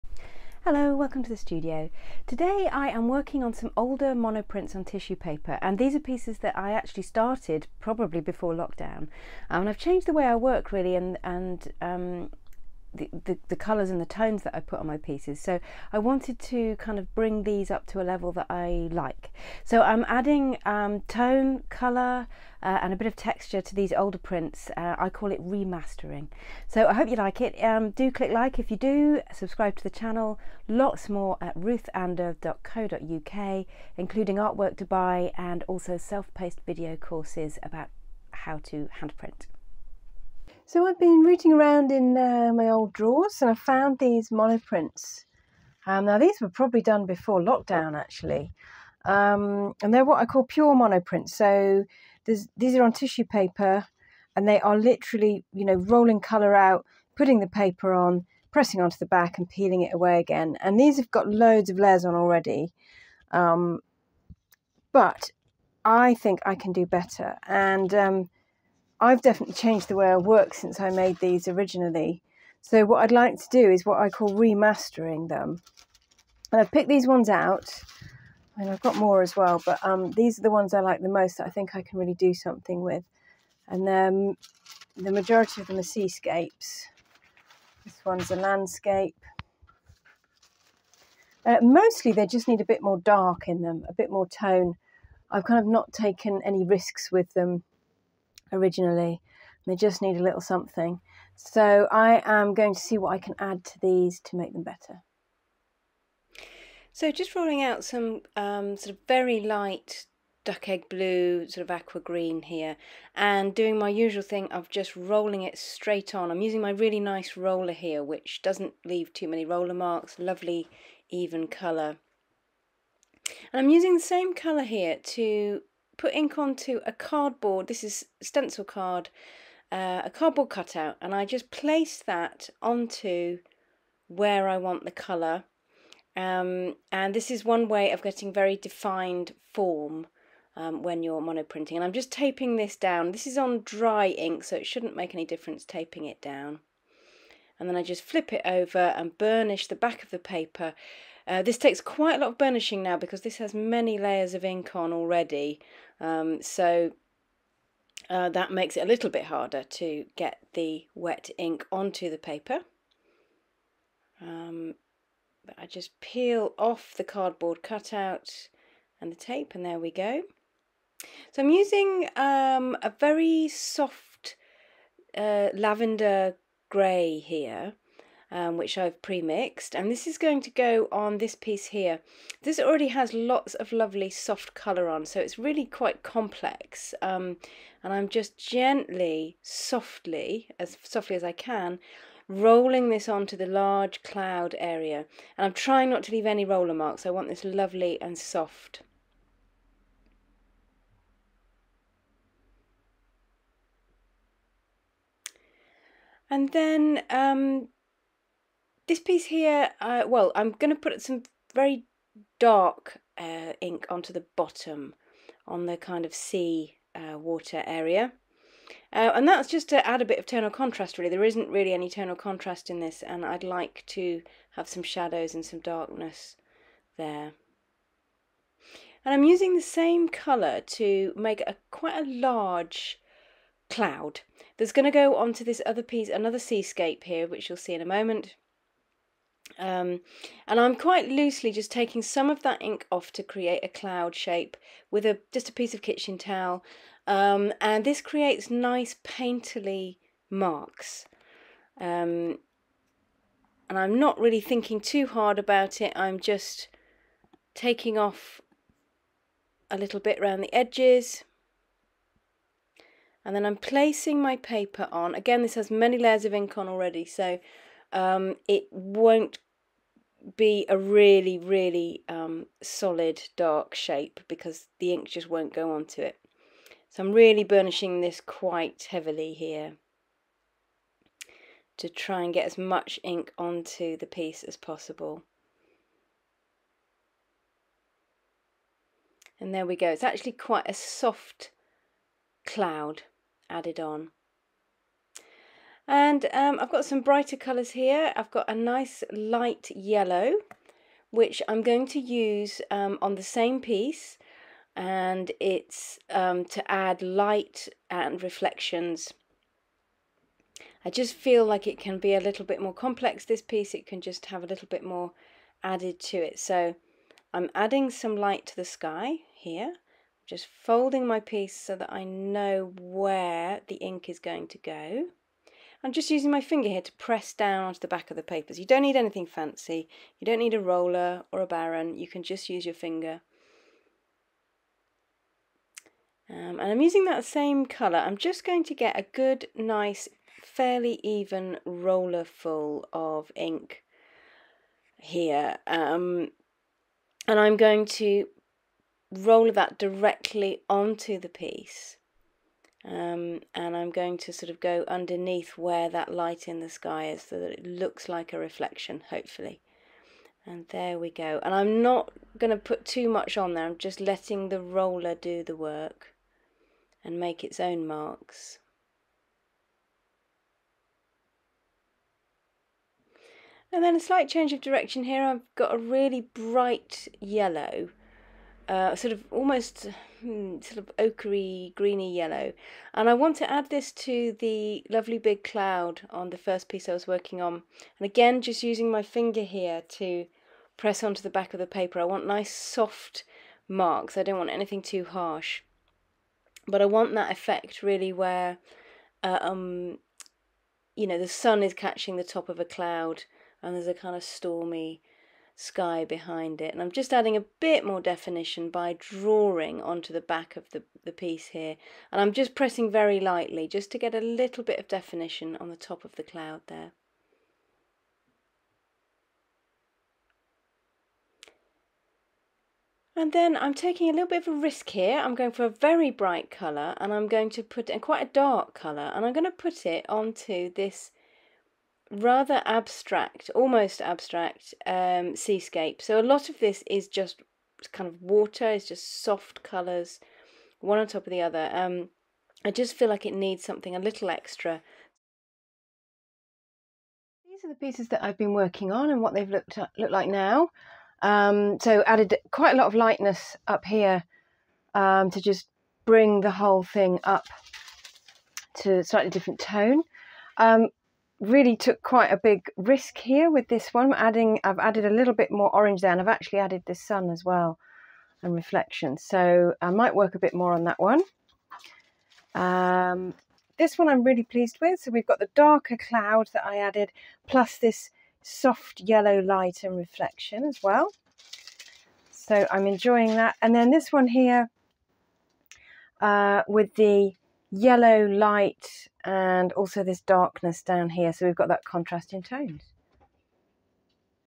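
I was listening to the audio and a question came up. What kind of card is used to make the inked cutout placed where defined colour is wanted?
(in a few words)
Stencil card.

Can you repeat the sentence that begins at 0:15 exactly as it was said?
So I wanted to kind of bring these up to a level that I like.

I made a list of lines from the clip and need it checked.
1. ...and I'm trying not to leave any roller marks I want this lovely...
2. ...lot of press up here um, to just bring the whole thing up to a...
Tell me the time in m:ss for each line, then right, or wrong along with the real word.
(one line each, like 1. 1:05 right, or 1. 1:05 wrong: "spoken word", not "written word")
1. 3:15 right
2. 7:32 wrong: "lightness", not "press".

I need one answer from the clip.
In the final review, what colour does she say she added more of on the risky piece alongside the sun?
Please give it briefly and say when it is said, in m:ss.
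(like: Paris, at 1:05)
Orange, at 7:45.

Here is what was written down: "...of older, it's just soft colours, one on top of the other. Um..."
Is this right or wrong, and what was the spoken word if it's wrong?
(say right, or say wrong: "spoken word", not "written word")
wrong: "water", not "older".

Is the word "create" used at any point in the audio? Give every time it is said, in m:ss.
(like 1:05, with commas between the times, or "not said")
4:03, 4:08.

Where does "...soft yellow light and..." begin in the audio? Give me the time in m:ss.
7:58.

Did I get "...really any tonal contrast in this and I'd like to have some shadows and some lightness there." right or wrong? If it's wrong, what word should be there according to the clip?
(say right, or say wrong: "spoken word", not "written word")
wrong: "darkness", not "lightness".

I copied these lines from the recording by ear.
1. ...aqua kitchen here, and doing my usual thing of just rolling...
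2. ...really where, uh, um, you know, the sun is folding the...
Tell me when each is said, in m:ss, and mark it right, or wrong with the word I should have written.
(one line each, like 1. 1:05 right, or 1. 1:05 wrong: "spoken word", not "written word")
1. 1:51 wrong: "green", not "kitchen"
2. 6:37 wrong: "catching", not "folding".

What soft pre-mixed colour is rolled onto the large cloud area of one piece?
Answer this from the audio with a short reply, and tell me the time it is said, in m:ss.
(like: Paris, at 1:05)
Lavender grey, at 2:55.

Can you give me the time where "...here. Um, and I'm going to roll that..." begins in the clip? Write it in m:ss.
5:44.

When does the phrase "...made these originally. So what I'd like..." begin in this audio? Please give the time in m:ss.
1:10.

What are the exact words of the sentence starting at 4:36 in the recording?
So I'm really burnishing this quite heavily here to try and get as much ink onto the piece as possible.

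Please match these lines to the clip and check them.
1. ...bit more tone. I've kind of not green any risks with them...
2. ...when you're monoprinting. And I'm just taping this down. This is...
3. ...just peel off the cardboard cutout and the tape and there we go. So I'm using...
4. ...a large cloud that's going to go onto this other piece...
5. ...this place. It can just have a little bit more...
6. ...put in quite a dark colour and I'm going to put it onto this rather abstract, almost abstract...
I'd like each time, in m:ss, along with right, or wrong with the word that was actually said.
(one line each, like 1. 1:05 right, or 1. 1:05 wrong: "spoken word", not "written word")
1. 1:33 wrong: "taken", not "green"
2. 2:20 right
3. 2:45 right
4. 3:51 right
5. 5:13 wrong: "piece", not "place"
6. 7:07 right.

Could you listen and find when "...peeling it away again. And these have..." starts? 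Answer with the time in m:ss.
0:59.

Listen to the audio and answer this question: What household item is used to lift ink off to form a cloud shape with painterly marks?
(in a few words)
Kitchen towel.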